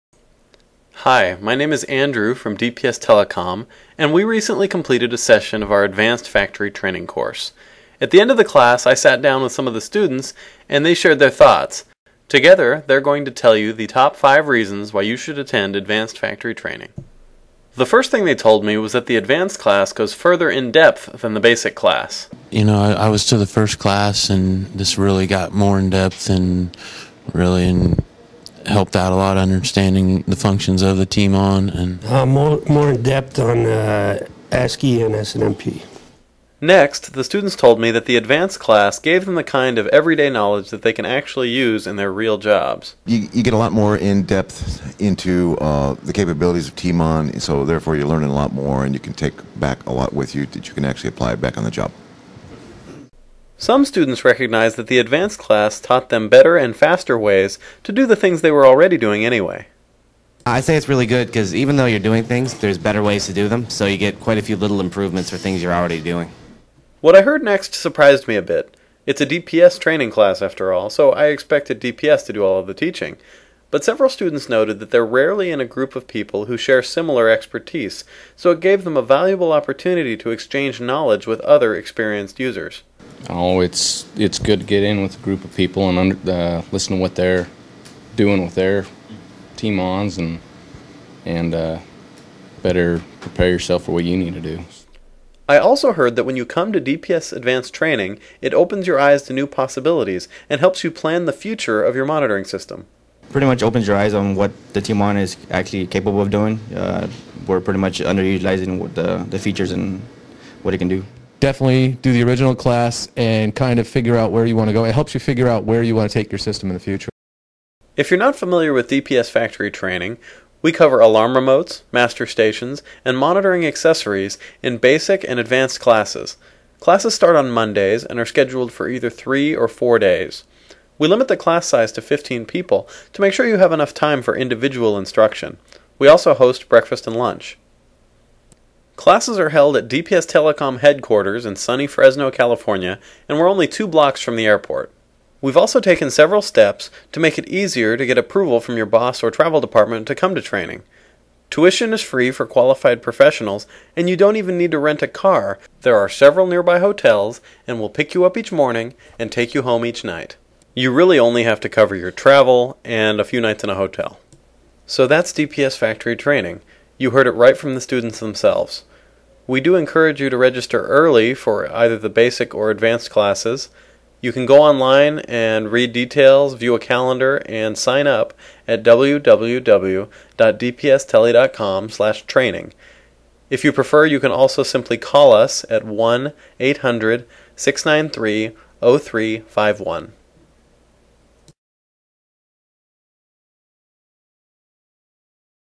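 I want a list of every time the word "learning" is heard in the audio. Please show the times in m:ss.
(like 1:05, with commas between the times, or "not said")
0:48.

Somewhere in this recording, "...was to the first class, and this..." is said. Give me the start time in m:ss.
0:23.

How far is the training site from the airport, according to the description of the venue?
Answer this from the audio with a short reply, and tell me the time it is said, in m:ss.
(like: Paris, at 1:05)
2 blocks, at 2:23.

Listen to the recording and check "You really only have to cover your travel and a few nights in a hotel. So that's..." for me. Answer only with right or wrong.
right.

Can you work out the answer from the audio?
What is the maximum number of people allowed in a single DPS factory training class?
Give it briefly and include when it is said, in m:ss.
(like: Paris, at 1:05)
15, at 2:12.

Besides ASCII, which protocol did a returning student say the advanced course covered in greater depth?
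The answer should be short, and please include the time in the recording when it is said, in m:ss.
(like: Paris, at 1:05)
SNMP, at 0:35.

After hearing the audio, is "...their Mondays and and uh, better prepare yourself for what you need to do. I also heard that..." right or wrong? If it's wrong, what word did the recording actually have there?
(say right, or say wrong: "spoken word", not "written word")
wrong: "TMONs", not "Mondays".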